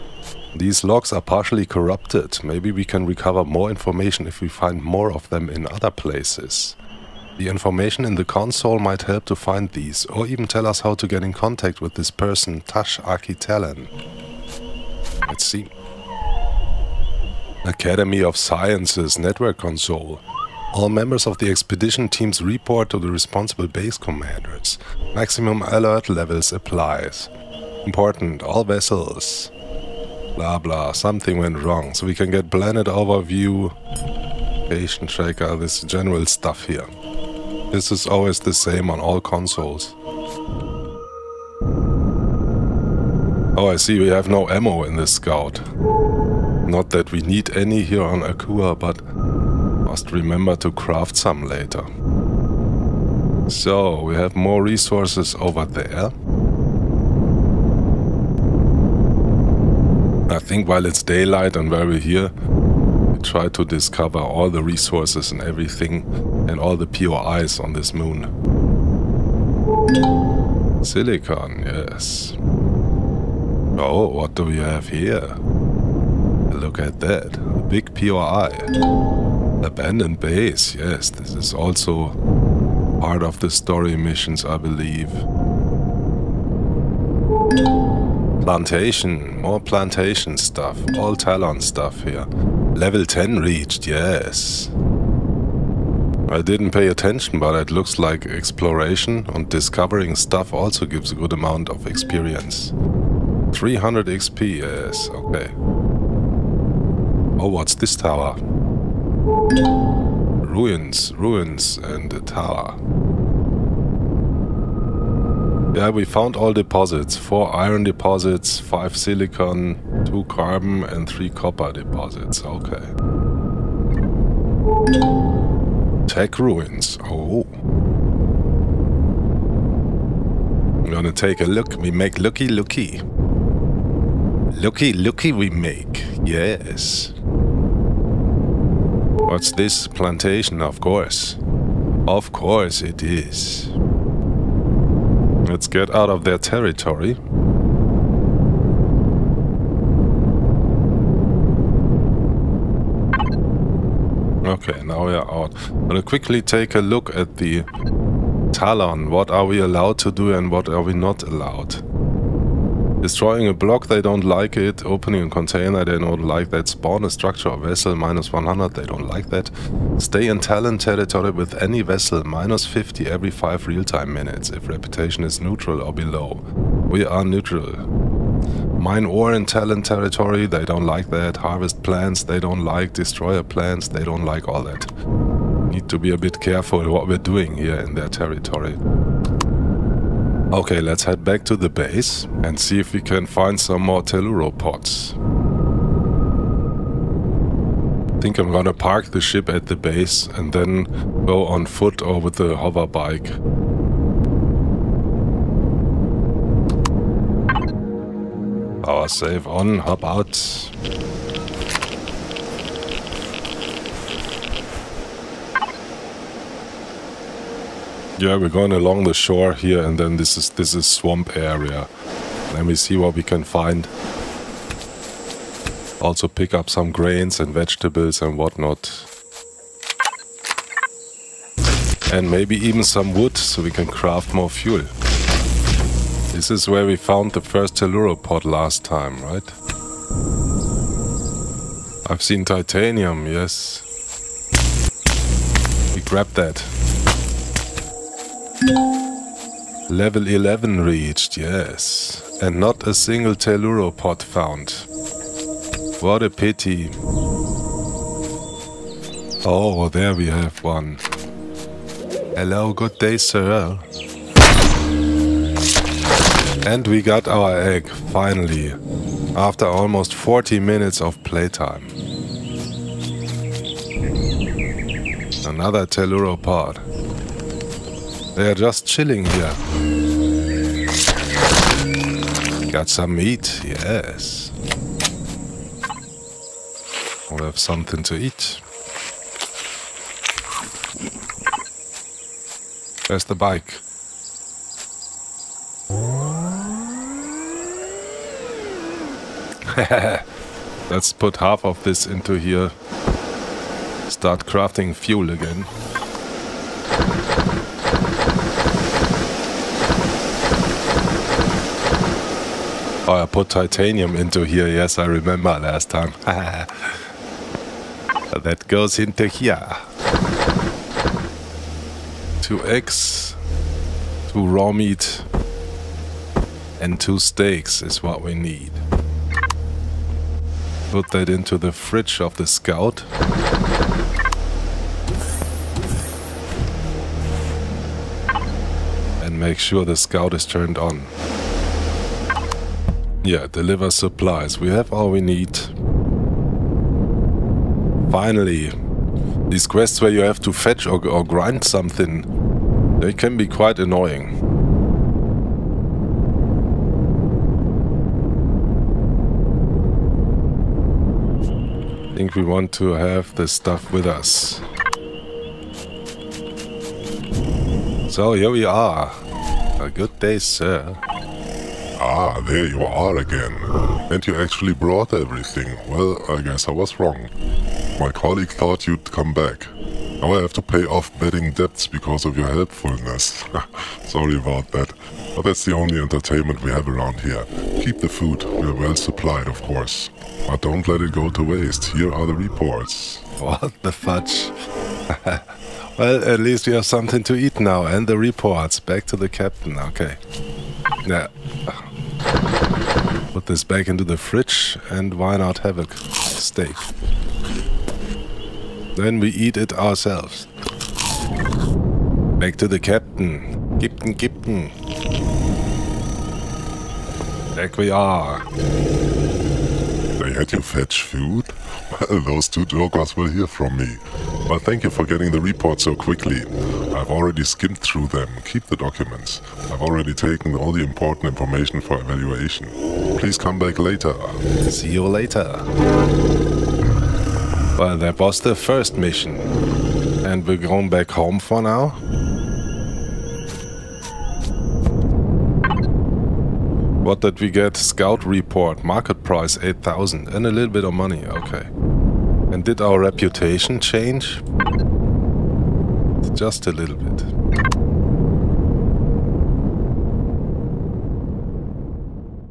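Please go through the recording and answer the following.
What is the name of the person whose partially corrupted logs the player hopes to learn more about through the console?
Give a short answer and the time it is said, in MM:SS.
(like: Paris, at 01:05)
Tash Akitelen, at 00:12.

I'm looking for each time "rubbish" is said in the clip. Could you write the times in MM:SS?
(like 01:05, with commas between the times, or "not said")
not said.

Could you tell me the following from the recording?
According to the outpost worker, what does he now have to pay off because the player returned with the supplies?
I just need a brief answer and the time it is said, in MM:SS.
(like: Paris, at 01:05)
betting debts, at 06:21.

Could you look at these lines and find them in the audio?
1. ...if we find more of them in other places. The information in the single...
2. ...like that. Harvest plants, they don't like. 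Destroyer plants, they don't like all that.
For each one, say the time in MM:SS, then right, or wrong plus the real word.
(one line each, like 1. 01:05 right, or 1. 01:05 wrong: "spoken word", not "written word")
1. 00:04 wrong: "console", not "single"
2. 03:00 right.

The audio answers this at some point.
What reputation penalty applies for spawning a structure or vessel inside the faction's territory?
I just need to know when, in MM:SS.
02:47.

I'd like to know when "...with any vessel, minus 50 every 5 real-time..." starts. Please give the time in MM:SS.
02:51.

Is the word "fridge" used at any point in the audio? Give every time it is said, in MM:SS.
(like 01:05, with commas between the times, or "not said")
05:31, 06:44.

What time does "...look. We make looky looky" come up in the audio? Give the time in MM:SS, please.
02:11.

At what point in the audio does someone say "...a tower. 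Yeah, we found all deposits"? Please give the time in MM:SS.
01:52.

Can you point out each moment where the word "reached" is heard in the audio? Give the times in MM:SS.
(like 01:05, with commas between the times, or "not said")
01:33, 04:10.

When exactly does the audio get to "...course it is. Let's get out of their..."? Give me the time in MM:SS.
02:22.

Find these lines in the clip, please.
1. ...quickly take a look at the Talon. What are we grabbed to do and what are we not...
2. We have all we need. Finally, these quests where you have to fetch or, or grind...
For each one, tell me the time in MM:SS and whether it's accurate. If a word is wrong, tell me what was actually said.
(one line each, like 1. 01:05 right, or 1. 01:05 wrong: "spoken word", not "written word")
1. 02:36 wrong: "allowed", not "grabbed"
2. 05:44 right.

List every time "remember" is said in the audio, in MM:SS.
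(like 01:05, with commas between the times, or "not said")
00:50, 05:15.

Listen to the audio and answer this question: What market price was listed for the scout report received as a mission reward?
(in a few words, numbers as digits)
8000.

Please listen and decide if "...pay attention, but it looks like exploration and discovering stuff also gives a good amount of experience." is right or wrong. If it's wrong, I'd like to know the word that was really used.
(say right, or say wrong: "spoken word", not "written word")
right.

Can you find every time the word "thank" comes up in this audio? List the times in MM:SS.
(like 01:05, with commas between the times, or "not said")
07:04.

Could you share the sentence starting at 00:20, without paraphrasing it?
All members of the expedition teams report to the responsible base commanders.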